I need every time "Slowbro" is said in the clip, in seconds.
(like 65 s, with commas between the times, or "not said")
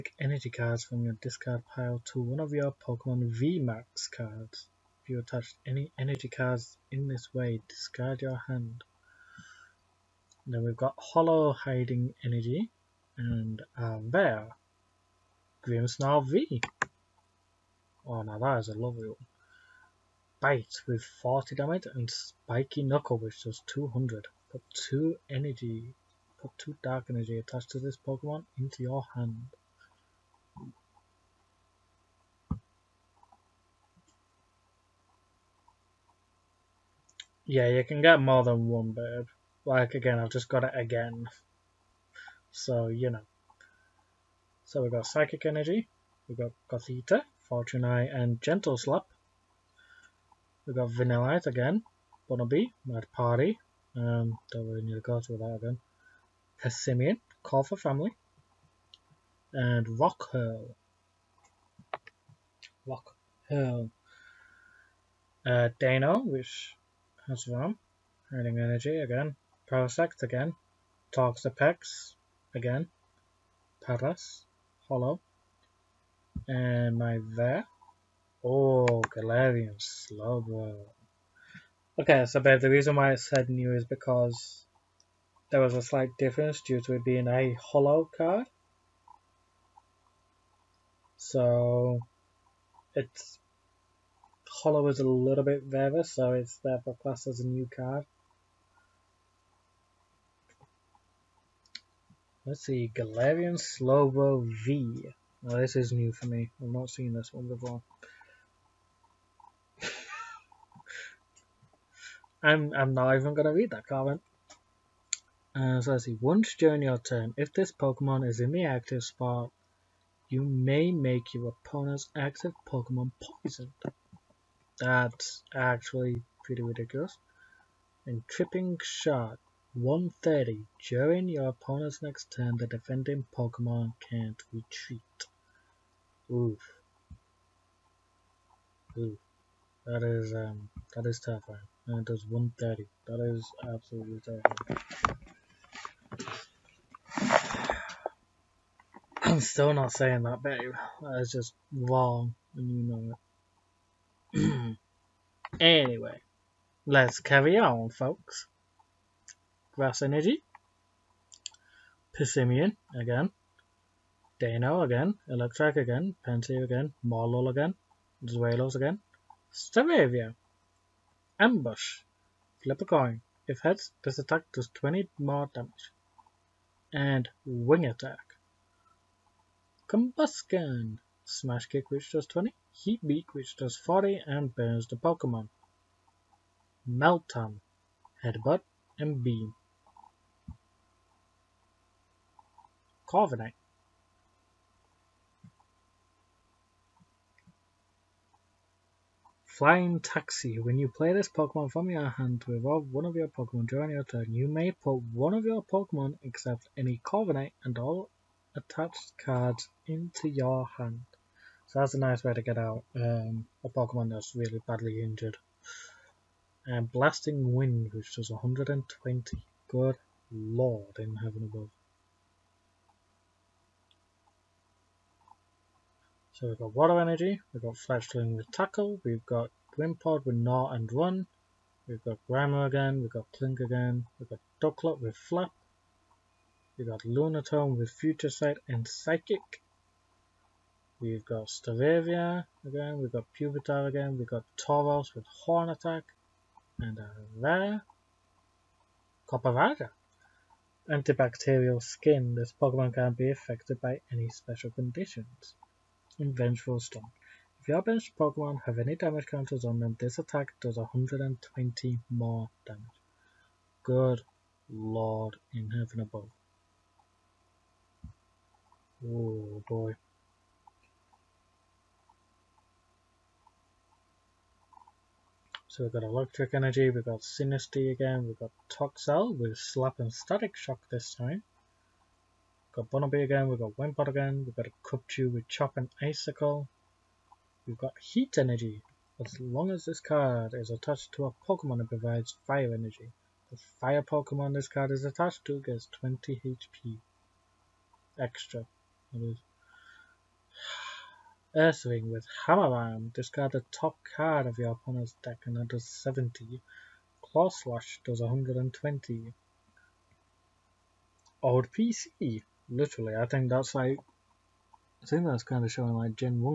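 79 s, 103 s.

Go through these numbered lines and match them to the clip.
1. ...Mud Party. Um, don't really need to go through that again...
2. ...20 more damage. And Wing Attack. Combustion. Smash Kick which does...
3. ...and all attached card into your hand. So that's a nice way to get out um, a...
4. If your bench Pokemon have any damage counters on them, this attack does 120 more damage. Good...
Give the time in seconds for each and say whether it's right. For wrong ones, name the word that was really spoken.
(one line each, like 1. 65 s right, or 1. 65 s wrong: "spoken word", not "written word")
1. 52 s right
2. 174 s right
3. 207 s right
4. 257 s right.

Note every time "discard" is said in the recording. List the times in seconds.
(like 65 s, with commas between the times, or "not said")
1 s, 7 s, 303 s.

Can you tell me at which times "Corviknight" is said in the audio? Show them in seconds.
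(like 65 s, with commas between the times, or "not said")
193 s, 207 s.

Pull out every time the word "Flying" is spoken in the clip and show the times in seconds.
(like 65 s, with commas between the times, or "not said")
199 s.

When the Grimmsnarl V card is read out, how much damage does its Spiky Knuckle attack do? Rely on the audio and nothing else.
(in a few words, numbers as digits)
200.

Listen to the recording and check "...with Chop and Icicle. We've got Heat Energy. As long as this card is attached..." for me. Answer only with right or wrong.
right.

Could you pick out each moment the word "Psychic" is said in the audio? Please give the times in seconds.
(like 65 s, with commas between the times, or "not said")
45 s, 238 s.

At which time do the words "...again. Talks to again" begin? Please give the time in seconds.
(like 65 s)
70 s.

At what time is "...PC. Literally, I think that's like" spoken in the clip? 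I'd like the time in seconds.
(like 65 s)
311 s.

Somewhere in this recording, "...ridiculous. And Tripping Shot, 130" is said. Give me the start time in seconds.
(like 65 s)
126 s.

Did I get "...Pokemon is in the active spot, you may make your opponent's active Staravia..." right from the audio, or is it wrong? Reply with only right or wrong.
wrong.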